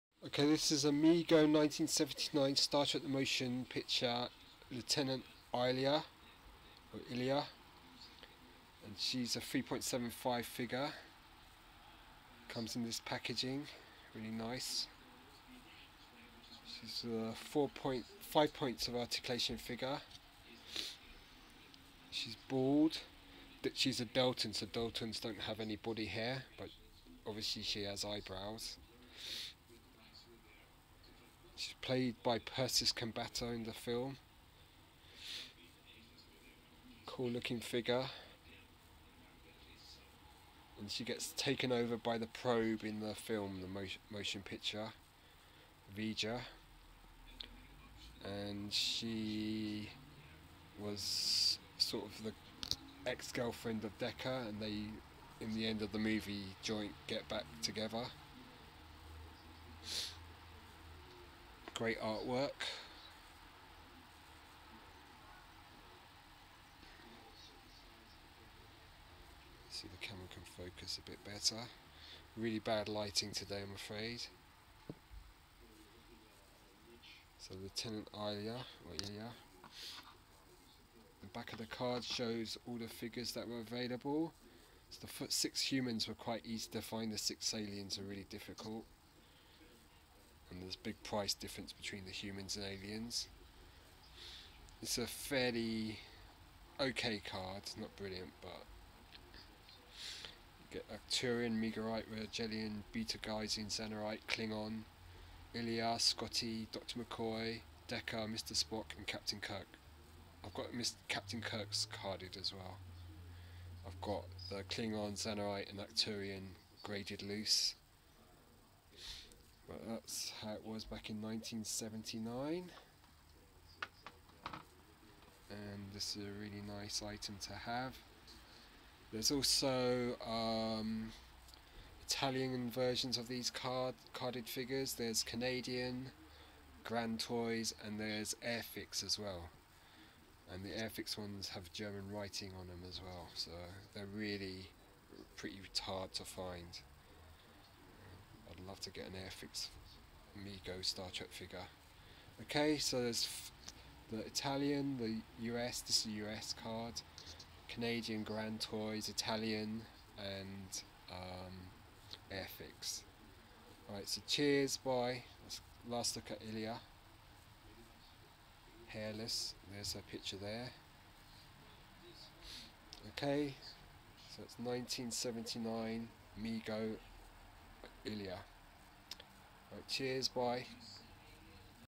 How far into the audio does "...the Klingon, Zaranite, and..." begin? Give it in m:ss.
1:54.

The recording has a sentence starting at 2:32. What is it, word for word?
Okay, so there's the Italian, the US, this is a US card, Canadian Grand Toys, Italian, and um, Airfix.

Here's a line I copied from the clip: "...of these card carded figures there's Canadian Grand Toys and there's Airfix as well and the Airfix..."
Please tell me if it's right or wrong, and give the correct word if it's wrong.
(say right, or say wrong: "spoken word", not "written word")
right.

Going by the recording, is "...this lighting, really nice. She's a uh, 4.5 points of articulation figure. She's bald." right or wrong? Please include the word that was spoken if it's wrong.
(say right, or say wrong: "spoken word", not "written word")
wrong: "packaging", not "lighting".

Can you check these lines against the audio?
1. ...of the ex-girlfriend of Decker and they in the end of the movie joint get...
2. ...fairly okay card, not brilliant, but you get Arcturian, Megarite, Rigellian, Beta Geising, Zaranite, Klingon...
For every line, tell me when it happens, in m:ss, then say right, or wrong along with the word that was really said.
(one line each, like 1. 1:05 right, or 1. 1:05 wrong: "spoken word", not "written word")
1. 0:52 right
2. 1:35 right.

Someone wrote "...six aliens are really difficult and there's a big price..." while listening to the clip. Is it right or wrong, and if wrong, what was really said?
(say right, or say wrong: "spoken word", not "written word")
right.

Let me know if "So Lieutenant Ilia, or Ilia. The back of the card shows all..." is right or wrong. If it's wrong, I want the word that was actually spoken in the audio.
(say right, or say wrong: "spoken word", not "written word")
right.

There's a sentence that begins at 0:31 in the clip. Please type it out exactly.
She's played by Persis Khambatta in the film.